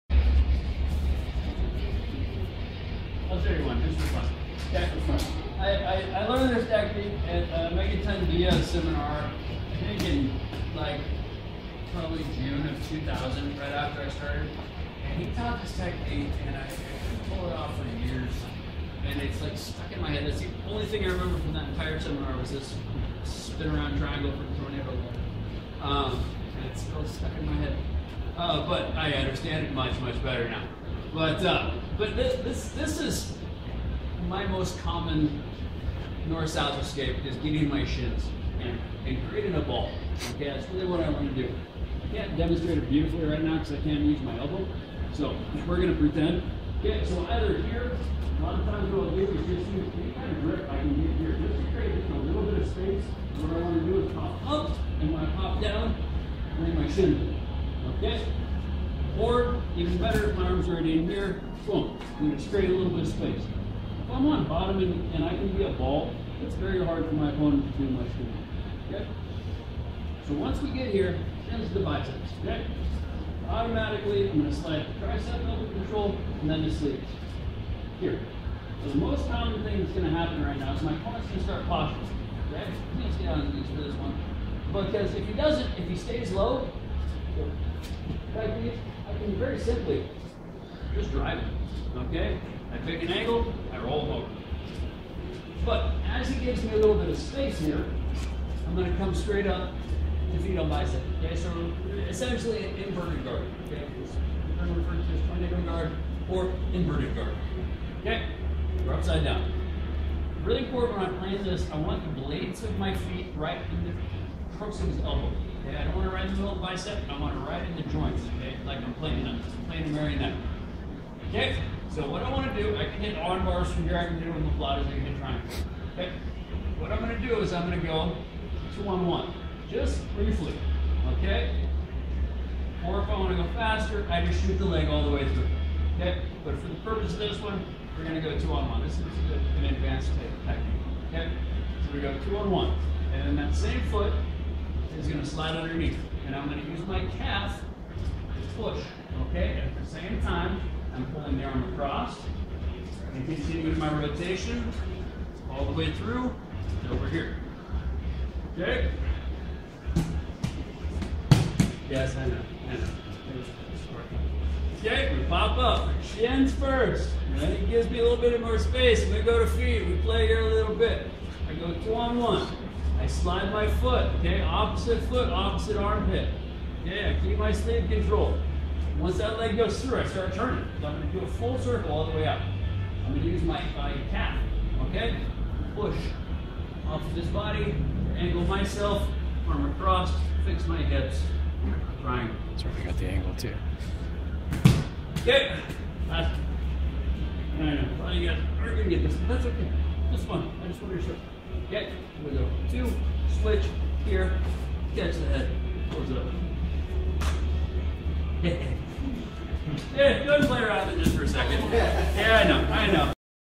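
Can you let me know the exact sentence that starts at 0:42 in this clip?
I can't demonstrate it beautifully right now because I can't use my elbow.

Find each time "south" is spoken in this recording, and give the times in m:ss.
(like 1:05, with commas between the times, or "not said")
0:36.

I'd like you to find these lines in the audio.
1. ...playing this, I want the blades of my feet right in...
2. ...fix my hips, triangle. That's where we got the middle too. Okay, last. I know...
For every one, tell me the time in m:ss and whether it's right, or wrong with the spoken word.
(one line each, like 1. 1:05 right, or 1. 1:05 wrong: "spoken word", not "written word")
1. 1:51 right
2. 3:10 wrong: "angle", not "middle".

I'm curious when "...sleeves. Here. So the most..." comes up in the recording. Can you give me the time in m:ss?
1:16.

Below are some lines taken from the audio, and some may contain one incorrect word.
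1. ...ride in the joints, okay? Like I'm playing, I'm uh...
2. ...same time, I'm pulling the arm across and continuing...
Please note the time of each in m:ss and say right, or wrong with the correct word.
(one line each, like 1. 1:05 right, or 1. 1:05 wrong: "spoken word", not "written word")
1. 1:57 right
2. 2:29 right.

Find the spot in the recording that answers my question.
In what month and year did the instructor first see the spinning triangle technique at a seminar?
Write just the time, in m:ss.
0:12.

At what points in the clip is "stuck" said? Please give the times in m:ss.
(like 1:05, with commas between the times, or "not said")
0:19, 0:27.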